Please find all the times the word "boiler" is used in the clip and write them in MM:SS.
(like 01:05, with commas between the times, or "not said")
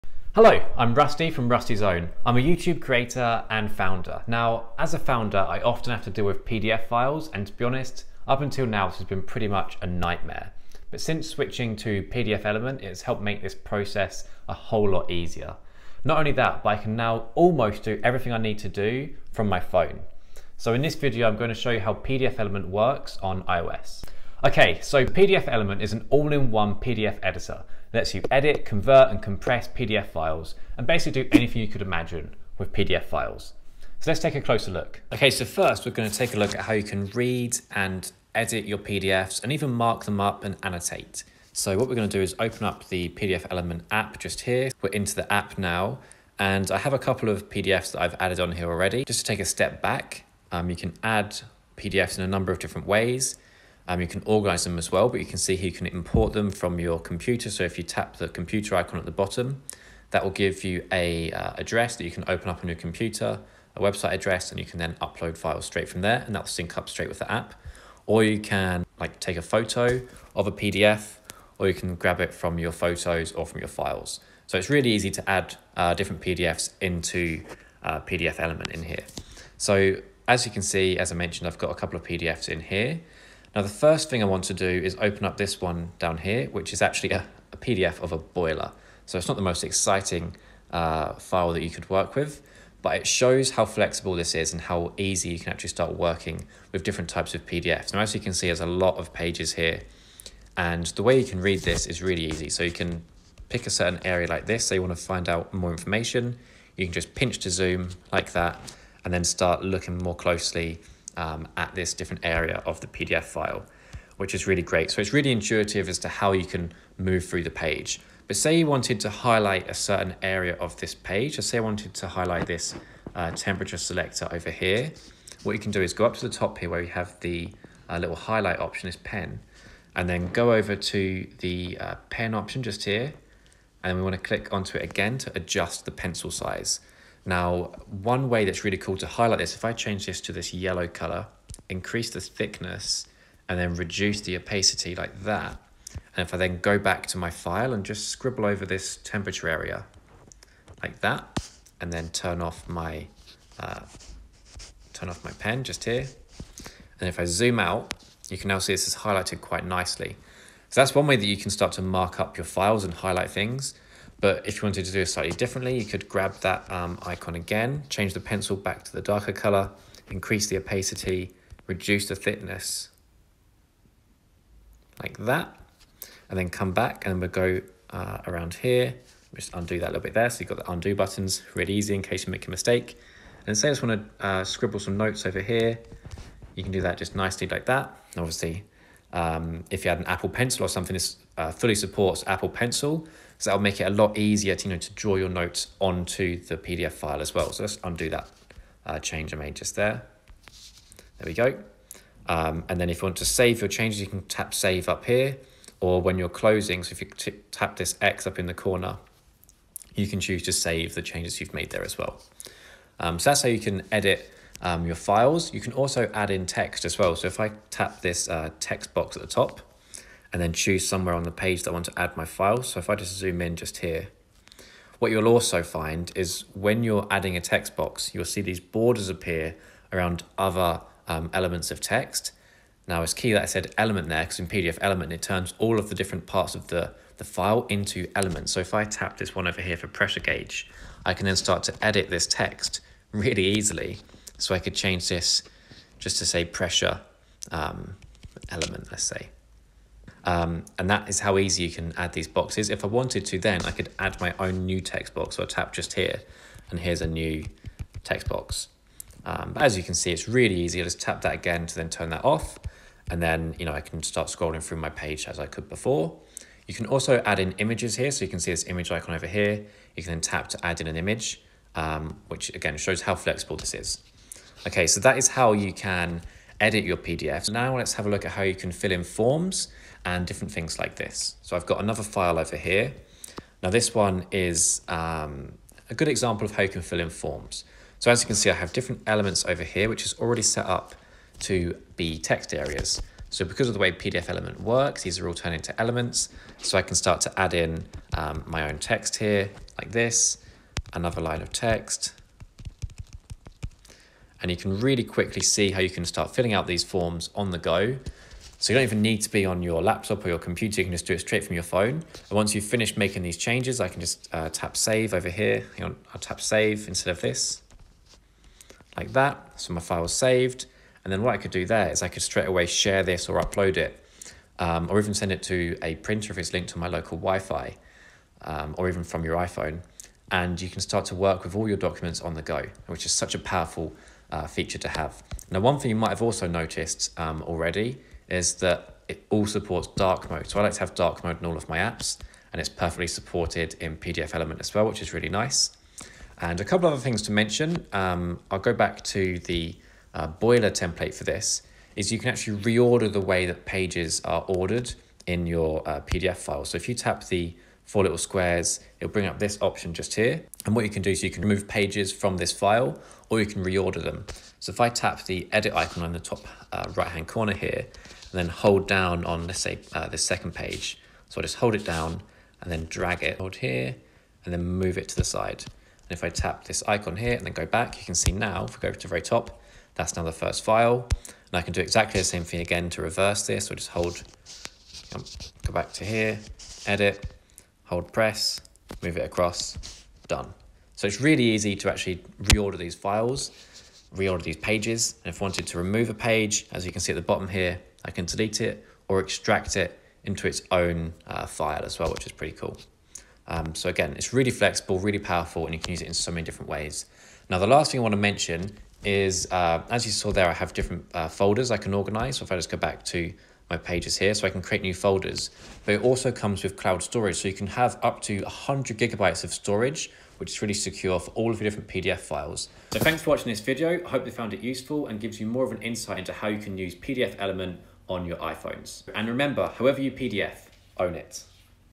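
01:28, 05:50.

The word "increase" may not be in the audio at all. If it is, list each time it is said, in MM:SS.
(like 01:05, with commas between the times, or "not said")
02:21, 02:50.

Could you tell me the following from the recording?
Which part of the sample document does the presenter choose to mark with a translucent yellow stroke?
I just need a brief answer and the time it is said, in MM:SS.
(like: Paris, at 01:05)
Temperature selector, at 02:03.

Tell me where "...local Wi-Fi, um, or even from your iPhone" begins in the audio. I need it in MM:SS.
05:26.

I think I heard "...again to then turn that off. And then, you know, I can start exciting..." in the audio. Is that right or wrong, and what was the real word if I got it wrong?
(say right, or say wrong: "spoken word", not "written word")
wrong: "scrolling", not "exciting".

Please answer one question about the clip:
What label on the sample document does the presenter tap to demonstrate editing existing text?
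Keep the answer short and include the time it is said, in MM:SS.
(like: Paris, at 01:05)
Pressure gauge, at 03:59.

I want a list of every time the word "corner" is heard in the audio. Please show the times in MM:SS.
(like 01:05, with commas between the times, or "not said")
03:28, 06:07.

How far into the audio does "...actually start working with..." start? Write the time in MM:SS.
01:35.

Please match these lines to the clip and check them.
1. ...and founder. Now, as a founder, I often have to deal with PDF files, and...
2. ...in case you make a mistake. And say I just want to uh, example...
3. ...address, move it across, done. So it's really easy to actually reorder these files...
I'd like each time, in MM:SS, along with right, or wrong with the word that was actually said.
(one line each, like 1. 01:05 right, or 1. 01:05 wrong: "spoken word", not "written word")
1. 00:03 right
2. 03:01 wrong: "scribble", not "example"
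3. 06:28 wrong: "press", not "address".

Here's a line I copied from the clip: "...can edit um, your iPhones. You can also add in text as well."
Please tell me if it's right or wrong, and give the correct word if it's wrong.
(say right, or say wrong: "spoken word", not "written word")
wrong: "files", not "iPhones".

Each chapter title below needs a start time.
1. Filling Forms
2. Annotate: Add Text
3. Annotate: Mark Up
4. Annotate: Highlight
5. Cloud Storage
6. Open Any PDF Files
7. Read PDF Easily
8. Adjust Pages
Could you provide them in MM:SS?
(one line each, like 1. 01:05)
1. 04:45
2. 03:40
3. 02:50
4. 02:11
5. 06:52
6. 01:06
7. 01:37
8. 05:57.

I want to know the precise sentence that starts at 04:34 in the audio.
Okay, so that is how you can edit your PDFs.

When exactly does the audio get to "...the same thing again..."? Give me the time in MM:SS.
06:22.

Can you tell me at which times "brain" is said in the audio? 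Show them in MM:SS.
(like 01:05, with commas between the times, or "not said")
not said.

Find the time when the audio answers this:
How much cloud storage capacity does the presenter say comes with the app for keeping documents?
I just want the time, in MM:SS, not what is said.
06:58.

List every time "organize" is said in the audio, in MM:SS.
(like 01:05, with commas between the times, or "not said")
00:54, 06:51.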